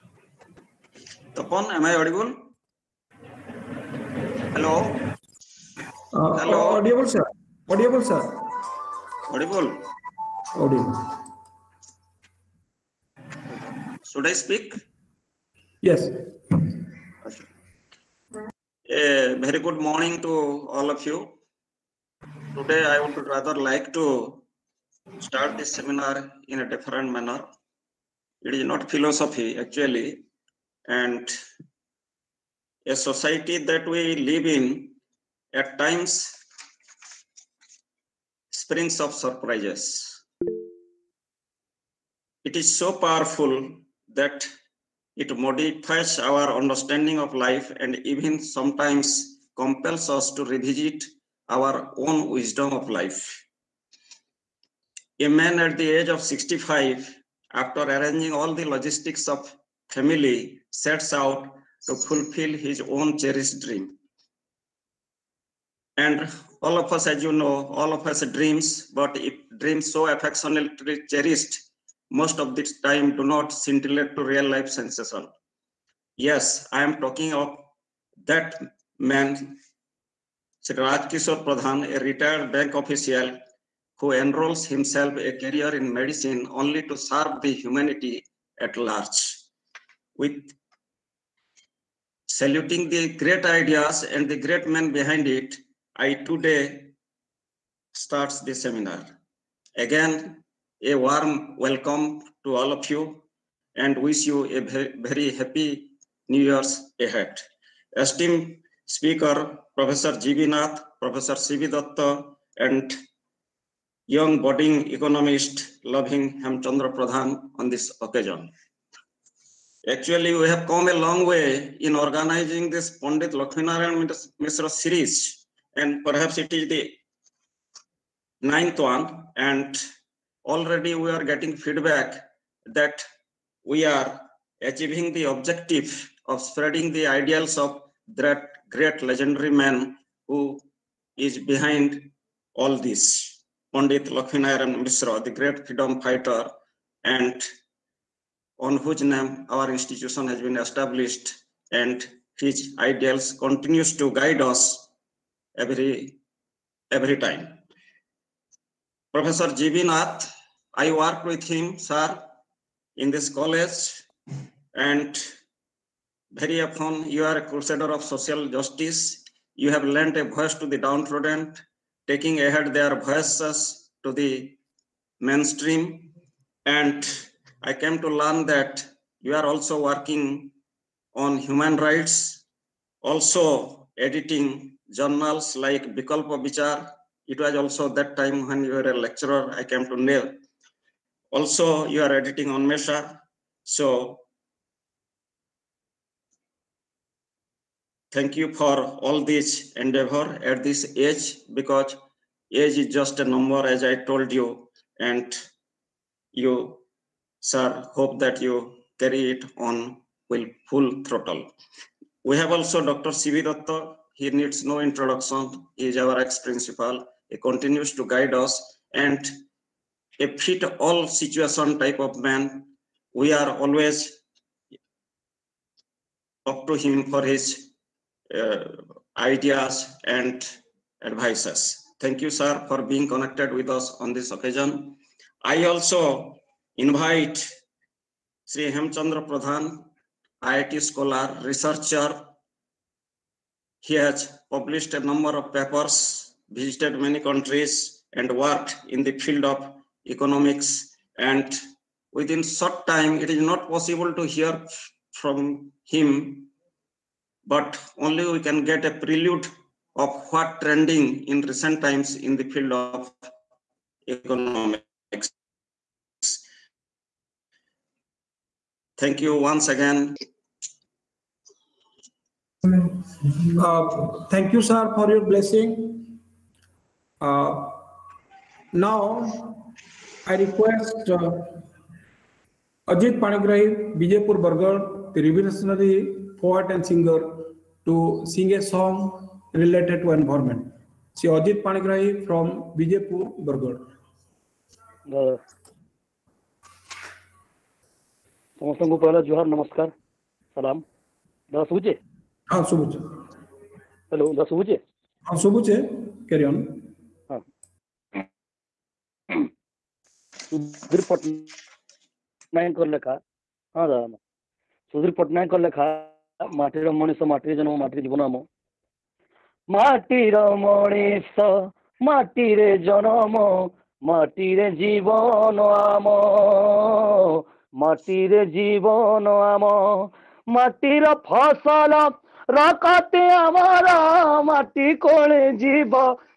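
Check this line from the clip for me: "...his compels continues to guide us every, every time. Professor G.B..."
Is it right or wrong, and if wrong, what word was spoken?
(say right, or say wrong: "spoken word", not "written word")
wrong: "ideals", not "compels".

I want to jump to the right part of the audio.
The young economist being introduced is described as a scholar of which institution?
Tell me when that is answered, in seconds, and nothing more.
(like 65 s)
240 s.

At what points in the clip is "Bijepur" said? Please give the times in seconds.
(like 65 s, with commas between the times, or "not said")
284 s, 292 s.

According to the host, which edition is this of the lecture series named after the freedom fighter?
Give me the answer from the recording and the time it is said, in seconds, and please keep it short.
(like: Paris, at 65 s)
ninth, at 128 s.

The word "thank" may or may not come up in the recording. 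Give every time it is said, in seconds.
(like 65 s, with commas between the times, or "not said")
198 s, 231 s, 269 s, 274 s.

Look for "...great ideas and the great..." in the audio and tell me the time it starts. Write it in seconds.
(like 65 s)
93 s.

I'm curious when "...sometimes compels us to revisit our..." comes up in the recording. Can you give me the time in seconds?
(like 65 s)
48 s.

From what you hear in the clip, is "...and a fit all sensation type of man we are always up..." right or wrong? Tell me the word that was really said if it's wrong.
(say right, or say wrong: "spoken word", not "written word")
wrong: "situation", not "sensation".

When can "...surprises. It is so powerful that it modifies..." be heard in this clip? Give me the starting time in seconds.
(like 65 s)
39 s.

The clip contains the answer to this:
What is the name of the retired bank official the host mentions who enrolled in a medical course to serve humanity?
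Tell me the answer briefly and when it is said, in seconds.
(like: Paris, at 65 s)
Kishor Pradhan, at 80 s.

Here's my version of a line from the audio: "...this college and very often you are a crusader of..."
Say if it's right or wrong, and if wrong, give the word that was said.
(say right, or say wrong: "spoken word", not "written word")
right.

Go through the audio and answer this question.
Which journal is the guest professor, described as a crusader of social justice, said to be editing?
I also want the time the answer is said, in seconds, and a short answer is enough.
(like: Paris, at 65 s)
Bikalpa Bichar, at 185 s.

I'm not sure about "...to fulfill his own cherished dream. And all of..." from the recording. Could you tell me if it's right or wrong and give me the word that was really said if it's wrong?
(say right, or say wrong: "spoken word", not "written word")
right.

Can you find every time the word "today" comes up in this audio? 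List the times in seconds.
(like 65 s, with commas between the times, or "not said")
22 s, 96 s.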